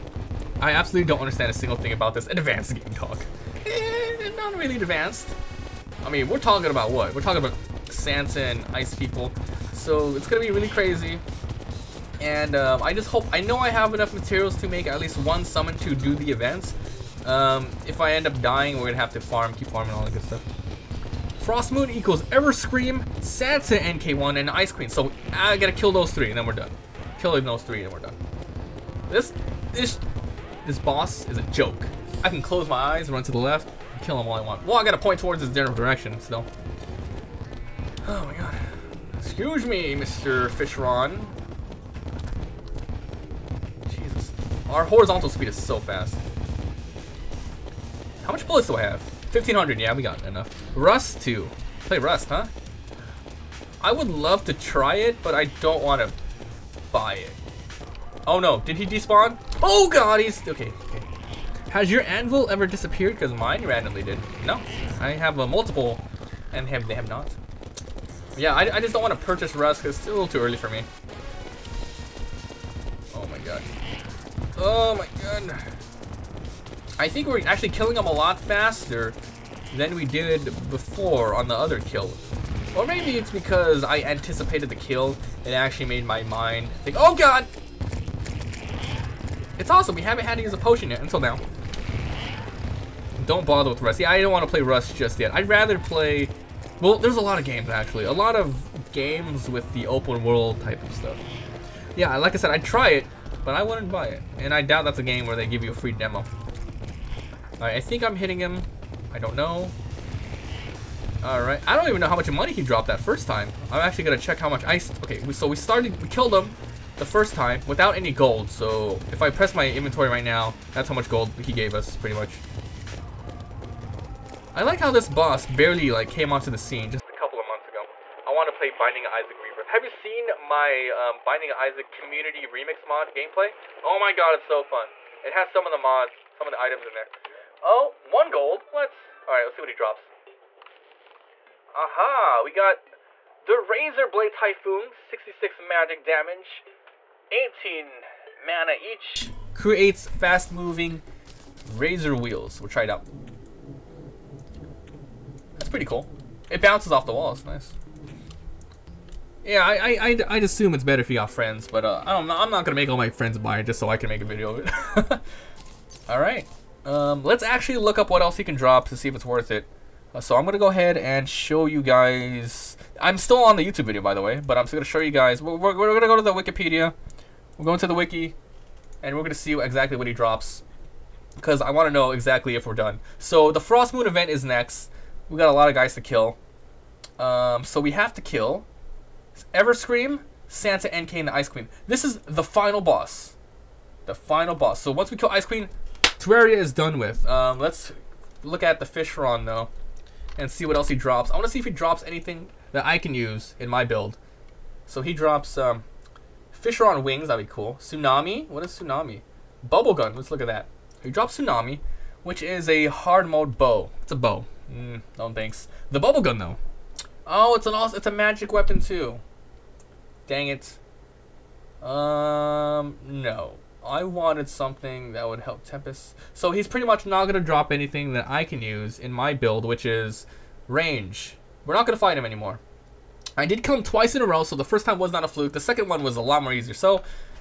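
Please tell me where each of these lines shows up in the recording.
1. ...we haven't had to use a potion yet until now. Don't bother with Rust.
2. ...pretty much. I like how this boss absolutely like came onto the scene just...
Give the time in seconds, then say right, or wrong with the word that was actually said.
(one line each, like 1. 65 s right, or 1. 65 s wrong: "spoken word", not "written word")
1. 89 s right
2. 121 s wrong: "barely", not "absolutely".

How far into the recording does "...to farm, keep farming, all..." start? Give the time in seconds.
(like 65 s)
19 s.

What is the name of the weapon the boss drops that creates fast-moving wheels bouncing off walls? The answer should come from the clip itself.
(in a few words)
Razor Blade Typhoon.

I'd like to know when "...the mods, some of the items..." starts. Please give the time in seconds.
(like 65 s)
135 s.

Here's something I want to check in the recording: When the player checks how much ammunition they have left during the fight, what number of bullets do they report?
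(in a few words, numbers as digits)
1500.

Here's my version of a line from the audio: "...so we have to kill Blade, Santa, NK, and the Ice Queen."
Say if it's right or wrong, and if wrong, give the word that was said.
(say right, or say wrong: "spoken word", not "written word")
wrong: "Everscream", not "Blade".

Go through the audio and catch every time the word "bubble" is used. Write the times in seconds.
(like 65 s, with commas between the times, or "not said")
209 s, 215 s.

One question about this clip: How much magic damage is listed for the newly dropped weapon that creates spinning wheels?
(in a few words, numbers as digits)
66.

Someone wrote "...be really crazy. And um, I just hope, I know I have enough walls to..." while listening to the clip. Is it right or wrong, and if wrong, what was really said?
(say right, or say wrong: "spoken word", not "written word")
wrong: "materials", not "walls".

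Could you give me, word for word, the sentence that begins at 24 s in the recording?
So I gotta kill those three, and then we're done.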